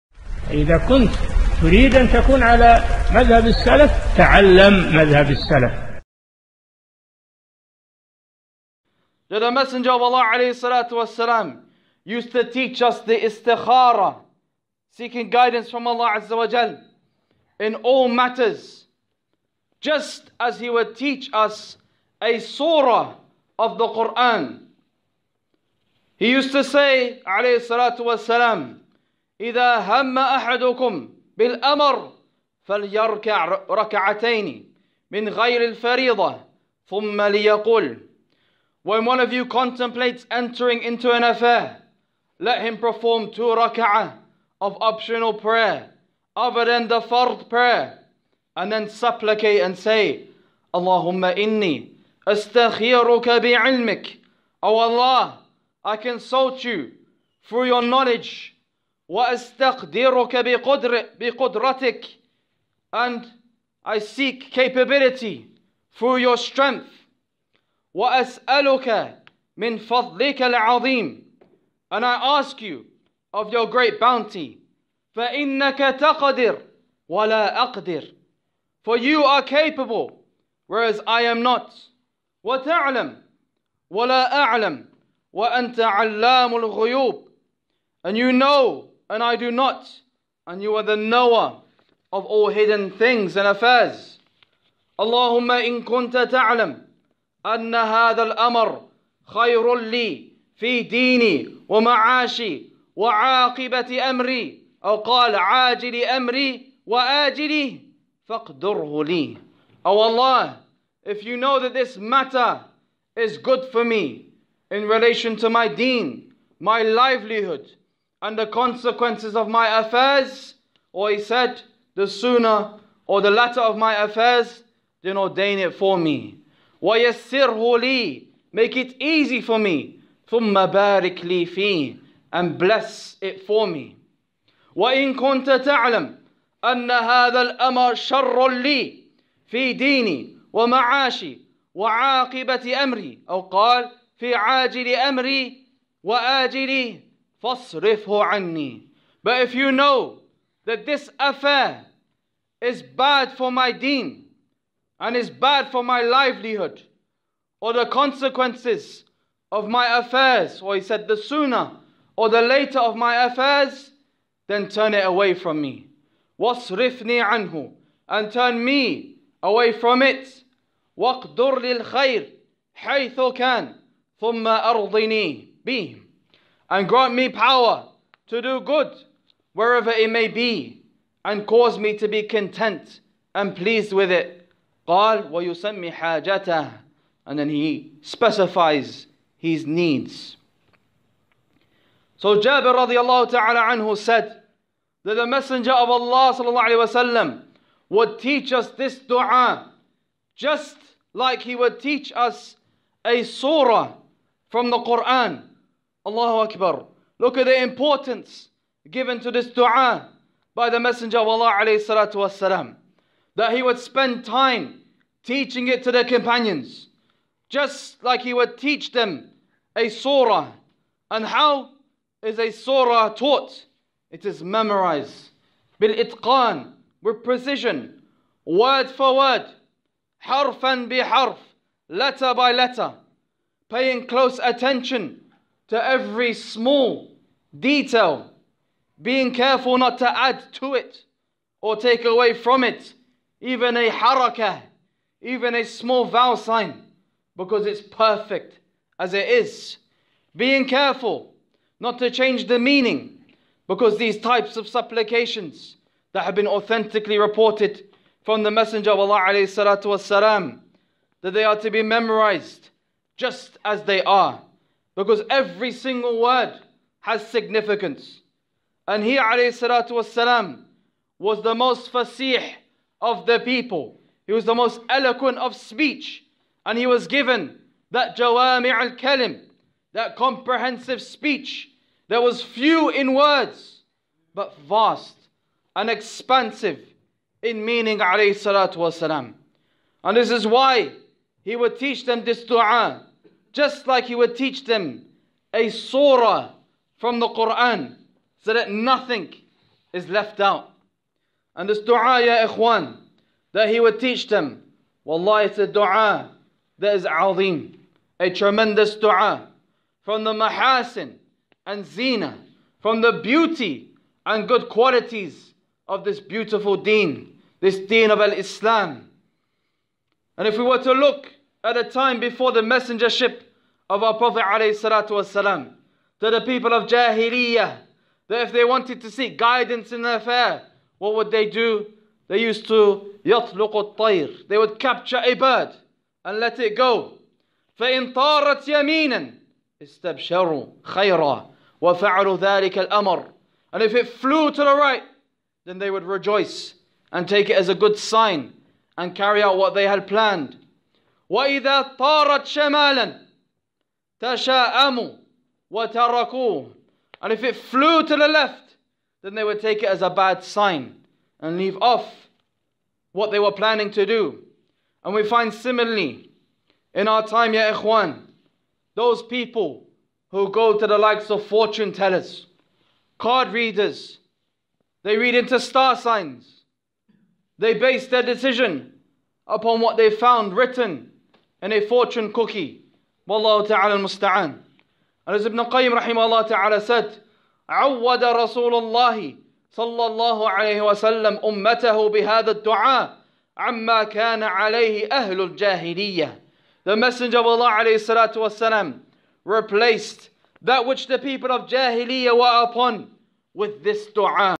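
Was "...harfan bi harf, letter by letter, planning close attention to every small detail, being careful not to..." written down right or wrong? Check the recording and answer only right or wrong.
wrong.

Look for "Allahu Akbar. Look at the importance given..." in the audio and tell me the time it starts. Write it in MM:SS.
03:26.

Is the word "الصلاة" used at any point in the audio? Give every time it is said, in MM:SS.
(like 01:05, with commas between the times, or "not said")
00:27, 06:37.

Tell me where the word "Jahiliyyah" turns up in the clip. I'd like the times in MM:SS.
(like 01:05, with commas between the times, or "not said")
05:26, 06:41.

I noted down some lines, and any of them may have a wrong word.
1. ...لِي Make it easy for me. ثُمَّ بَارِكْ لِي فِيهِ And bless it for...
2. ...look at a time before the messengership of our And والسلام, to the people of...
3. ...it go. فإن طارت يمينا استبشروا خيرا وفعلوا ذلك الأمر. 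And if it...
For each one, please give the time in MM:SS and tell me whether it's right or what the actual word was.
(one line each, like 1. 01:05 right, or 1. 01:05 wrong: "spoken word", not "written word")
1. 02:07 right
2. 05:20 wrong: "Prophet", not "And"
3. 05:36 right.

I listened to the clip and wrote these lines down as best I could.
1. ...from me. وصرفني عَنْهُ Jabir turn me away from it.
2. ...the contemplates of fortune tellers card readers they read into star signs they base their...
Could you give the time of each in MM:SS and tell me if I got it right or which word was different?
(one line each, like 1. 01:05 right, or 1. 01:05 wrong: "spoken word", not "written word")
1. 02:45 wrong: "And", not "Jabir"
2. 06:10 wrong: "likes", not "contemplates".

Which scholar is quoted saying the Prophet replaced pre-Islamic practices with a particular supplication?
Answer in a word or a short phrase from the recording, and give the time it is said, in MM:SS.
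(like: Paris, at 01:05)
Ibn Qayyim, at 06:25.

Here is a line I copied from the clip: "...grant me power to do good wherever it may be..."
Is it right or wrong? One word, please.
right.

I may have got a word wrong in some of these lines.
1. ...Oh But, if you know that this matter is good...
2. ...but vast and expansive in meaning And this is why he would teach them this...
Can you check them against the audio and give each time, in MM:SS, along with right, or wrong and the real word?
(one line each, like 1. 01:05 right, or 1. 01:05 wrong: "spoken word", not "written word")
1. 01:49 wrong: "Allah", not "But"
2. 04:44 right.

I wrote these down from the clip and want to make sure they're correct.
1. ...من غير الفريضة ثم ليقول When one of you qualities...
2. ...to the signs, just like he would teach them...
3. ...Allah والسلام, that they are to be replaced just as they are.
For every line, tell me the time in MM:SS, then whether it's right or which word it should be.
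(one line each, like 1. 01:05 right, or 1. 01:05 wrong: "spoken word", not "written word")
1. 00:35 wrong: "contemplates", not "qualities"
2. 03:35 wrong: "companions", not "signs"
3. 04:18 wrong: "memorized", not "replaced".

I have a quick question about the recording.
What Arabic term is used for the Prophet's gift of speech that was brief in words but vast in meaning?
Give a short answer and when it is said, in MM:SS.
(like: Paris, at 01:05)
jawami' al-kalim, at 04:38.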